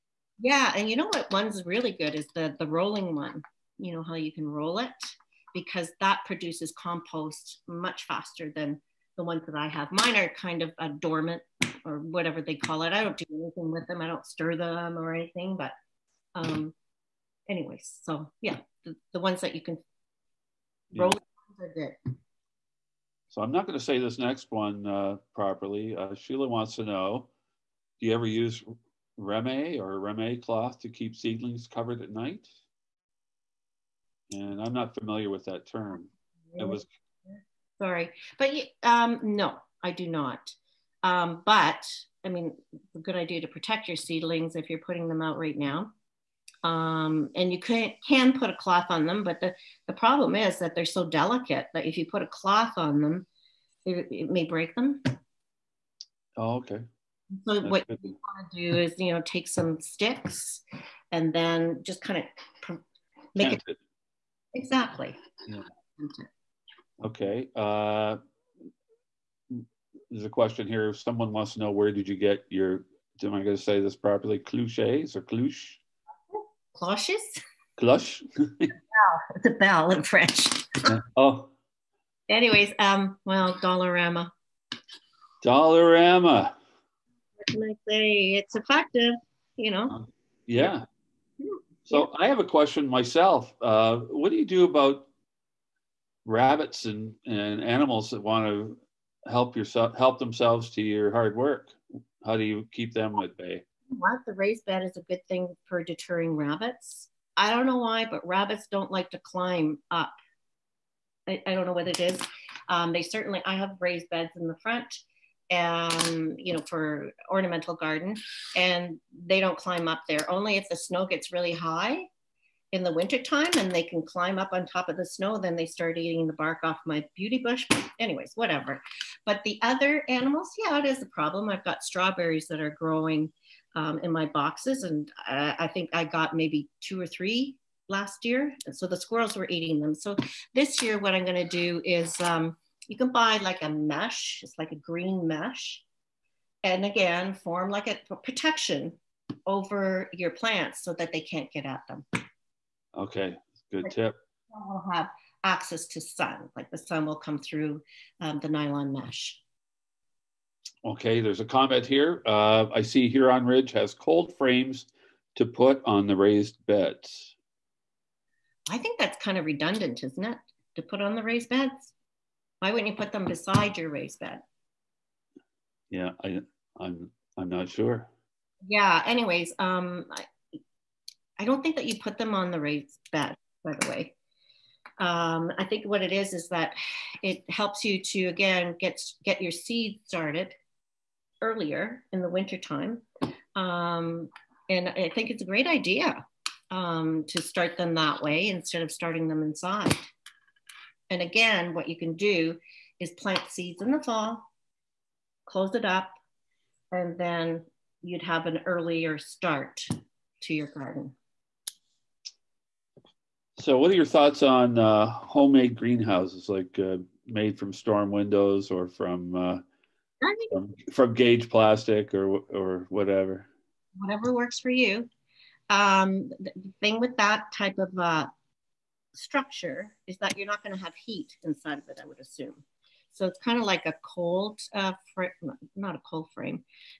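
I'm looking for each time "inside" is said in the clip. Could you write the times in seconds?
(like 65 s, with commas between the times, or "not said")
199 s, 231 s.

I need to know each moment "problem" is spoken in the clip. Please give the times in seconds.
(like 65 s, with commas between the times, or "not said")
49 s, 131 s.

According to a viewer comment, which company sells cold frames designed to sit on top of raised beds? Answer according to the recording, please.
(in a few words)
Huron Ridge.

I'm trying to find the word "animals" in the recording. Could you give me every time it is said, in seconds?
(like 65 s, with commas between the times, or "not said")
97 s, 130 s.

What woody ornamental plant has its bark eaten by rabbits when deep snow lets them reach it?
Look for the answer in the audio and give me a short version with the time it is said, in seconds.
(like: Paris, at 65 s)
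beauty bush, at 127 s.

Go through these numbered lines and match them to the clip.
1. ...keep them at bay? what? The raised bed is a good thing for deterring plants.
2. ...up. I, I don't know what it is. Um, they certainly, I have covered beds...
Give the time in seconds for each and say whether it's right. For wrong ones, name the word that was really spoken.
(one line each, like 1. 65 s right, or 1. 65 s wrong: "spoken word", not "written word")
1. 102 s wrong: "rabbits", not "plants"
2. 109 s wrong: "raised", not "covered".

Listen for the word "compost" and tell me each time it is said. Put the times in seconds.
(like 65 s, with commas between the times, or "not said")
6 s.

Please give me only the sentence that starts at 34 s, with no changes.
And I'm not familiar with that term.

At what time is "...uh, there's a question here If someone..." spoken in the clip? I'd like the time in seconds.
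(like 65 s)
67 s.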